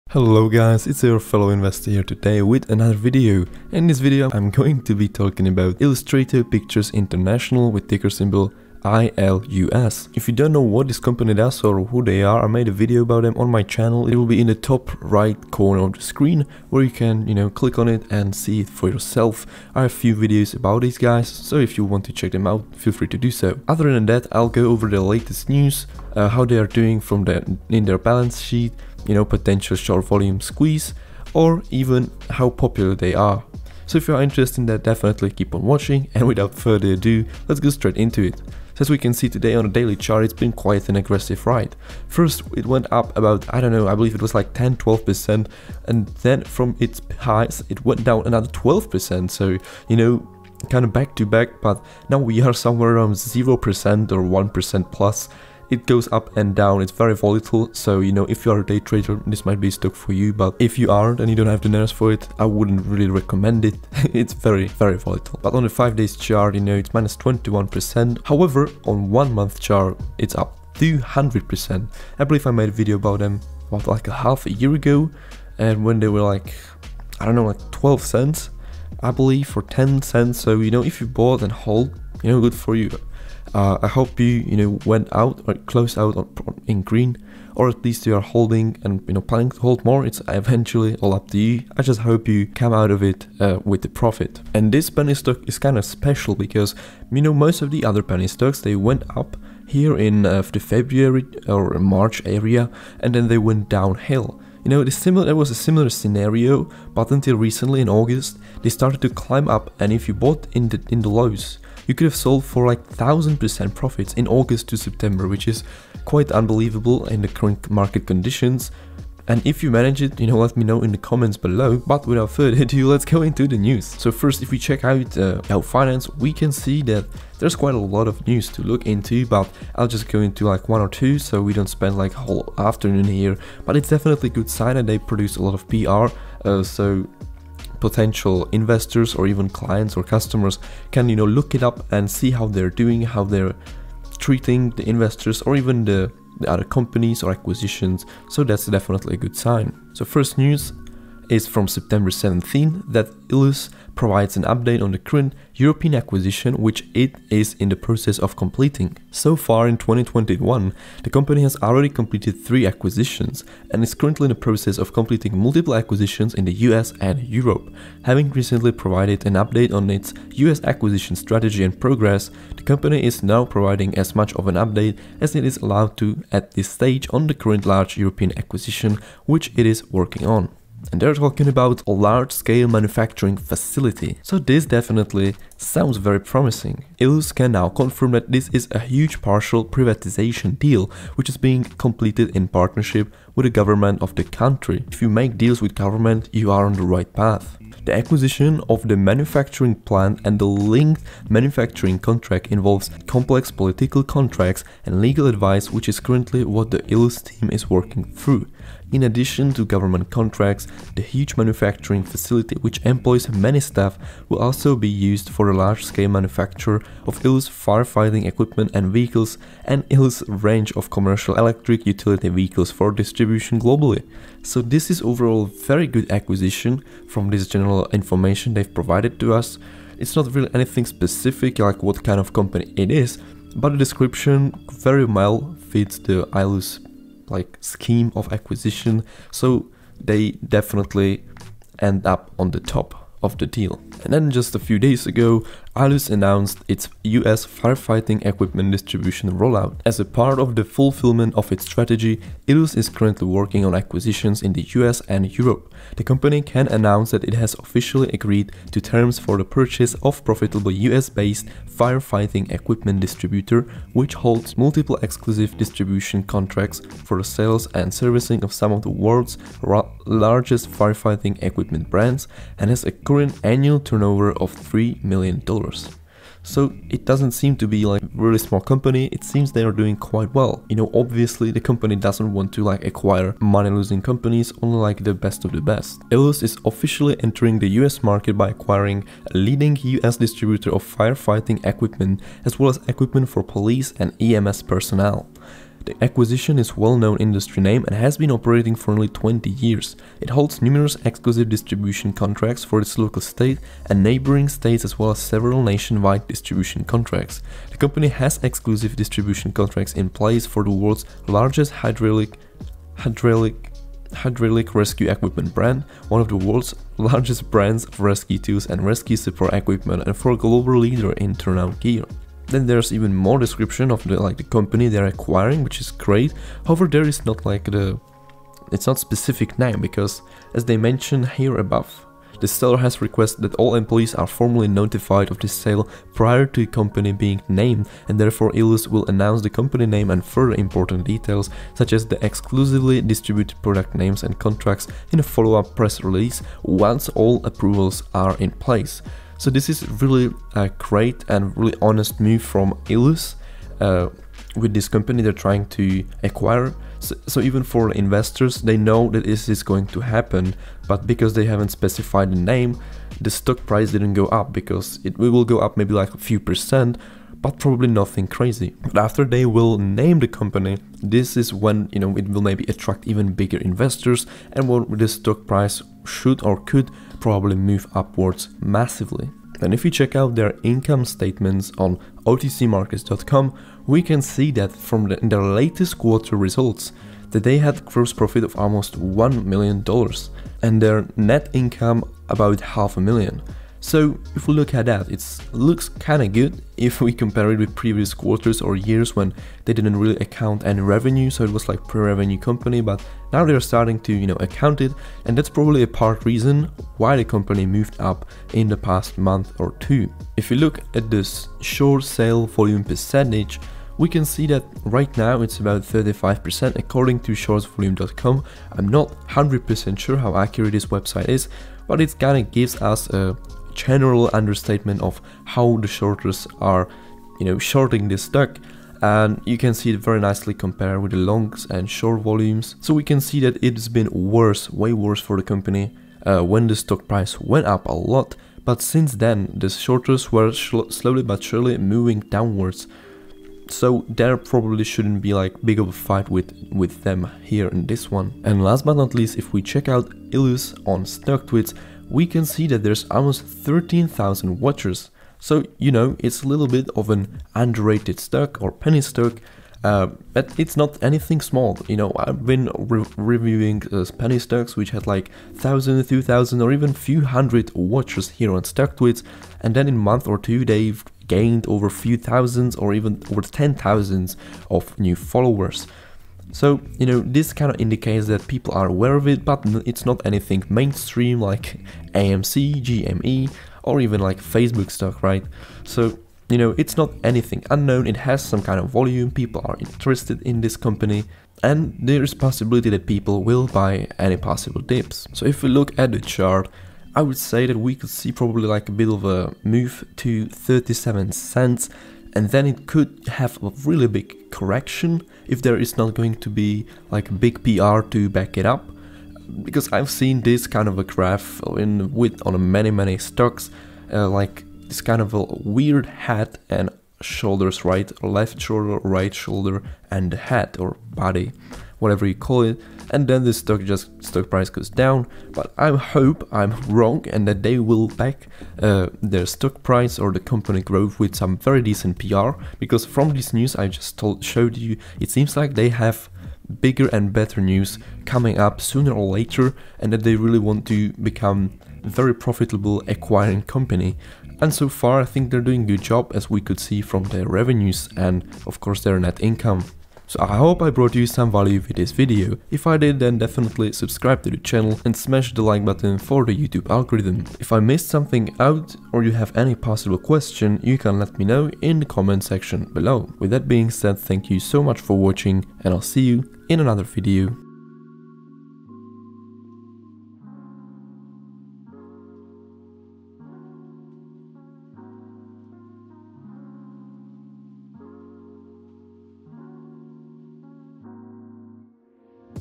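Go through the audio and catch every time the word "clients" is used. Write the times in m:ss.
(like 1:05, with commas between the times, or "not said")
2:19.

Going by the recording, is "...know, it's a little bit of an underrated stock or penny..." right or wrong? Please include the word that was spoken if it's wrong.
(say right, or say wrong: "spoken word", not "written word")
right.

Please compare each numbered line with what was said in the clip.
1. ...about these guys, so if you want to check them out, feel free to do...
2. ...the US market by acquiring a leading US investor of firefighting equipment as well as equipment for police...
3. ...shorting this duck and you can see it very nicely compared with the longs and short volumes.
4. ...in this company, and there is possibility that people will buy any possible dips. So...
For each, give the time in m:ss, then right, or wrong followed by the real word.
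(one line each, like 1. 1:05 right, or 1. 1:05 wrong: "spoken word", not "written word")
1. 0:20 right
2. 4:47 wrong: "distributor", not "investor"
3. 7:07 right
4. 8:10 right.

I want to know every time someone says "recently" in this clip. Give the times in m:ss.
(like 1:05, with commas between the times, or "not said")
1:47, 2:48.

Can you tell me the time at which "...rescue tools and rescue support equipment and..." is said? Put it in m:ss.
5:17.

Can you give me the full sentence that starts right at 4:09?
As a part of the fulfillment of its strategy, ILUS is currently working on acquisitions in the US and Europe.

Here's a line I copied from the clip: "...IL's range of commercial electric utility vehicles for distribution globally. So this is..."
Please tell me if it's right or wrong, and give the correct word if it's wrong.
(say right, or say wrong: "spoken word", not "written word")
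right.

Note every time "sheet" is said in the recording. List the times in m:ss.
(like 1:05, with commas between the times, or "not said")
0:28.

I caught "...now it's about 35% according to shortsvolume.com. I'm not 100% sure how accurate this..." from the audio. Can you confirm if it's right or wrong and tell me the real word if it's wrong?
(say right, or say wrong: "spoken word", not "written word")
right.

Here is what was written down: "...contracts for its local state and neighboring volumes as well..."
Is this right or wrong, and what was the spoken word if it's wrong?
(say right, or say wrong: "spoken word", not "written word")
wrong: "states", not "volumes".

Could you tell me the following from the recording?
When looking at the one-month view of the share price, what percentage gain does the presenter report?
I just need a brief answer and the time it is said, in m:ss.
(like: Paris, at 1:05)
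200%, at 1:10.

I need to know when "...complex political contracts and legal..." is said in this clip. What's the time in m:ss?
3:23.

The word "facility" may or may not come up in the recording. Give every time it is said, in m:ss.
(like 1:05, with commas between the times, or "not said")
3:03, 3:32.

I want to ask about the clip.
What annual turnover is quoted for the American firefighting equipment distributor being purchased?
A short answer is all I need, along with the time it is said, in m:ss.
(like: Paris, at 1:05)
$3 million, at 4:34.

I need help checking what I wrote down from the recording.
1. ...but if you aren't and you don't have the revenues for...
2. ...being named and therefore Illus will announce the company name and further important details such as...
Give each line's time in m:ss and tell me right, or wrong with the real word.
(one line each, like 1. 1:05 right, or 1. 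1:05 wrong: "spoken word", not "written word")
1. 1:00 wrong: "nerves", not "revenues"
2. 5:37 right.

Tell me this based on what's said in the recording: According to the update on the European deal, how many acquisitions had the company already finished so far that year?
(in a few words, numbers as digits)
3.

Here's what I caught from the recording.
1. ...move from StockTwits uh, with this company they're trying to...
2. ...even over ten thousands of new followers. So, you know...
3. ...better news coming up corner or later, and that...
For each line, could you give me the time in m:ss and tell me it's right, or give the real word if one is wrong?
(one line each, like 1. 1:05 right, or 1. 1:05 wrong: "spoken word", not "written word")
1. 5:52 wrong: "Illus", not "StockTwits"
2. 7:52 right
3. 8:57 wrong: "sooner", not "corner".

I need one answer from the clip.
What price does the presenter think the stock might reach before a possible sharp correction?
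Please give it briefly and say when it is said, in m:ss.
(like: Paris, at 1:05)
37 cents, at 8:20.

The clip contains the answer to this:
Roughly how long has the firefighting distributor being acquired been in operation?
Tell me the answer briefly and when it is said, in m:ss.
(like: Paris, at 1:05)
nearly 20 years, at 4:58.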